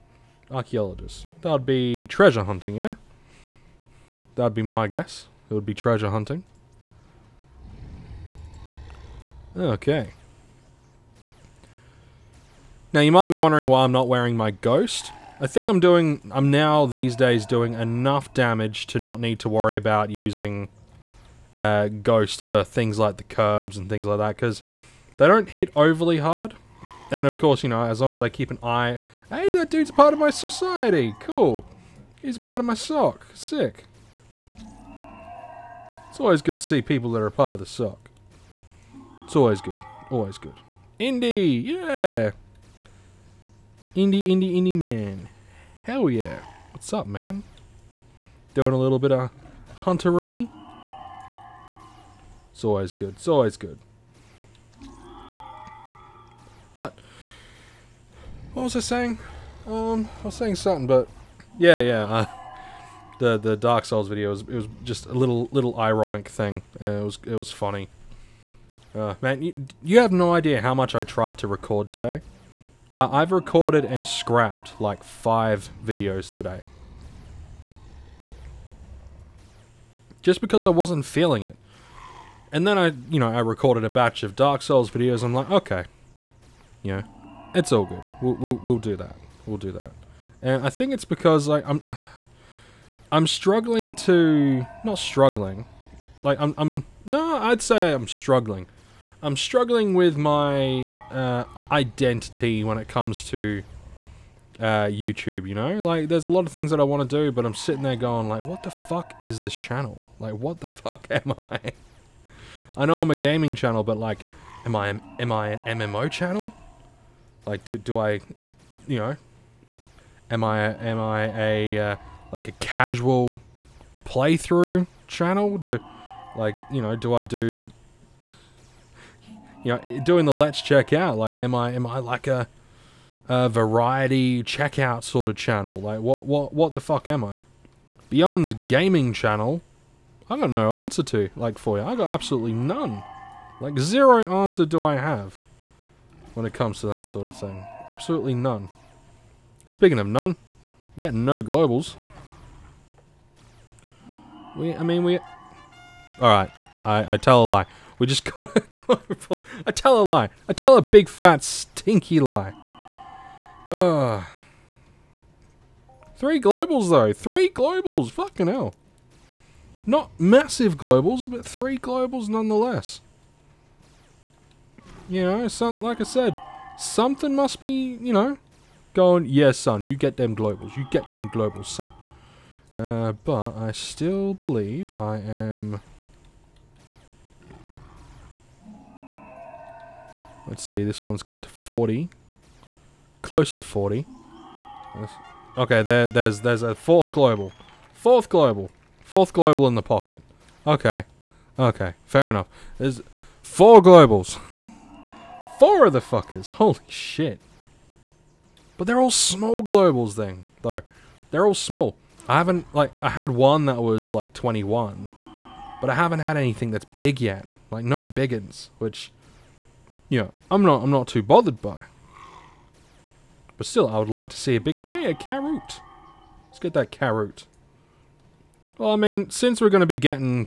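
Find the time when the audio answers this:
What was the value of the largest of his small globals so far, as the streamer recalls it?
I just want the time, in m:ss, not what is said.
3:34.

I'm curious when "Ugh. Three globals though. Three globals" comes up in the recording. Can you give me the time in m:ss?
2:43.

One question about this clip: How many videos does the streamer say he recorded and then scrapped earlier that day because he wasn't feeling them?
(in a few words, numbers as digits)
5.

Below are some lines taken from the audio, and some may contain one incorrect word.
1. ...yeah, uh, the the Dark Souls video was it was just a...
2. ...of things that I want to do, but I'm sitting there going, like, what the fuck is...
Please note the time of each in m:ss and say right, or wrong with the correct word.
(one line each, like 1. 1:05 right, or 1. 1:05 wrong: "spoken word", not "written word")
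1. 1:01 right
2. 1:46 right.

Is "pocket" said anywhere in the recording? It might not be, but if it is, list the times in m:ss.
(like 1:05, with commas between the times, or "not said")
3:19.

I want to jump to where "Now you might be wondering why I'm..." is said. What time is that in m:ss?
0:12.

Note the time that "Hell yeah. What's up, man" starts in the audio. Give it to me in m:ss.
0:45.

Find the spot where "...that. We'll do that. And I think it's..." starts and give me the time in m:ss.
1:28.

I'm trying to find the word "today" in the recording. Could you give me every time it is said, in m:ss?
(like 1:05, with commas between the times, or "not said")
1:11, 1:16.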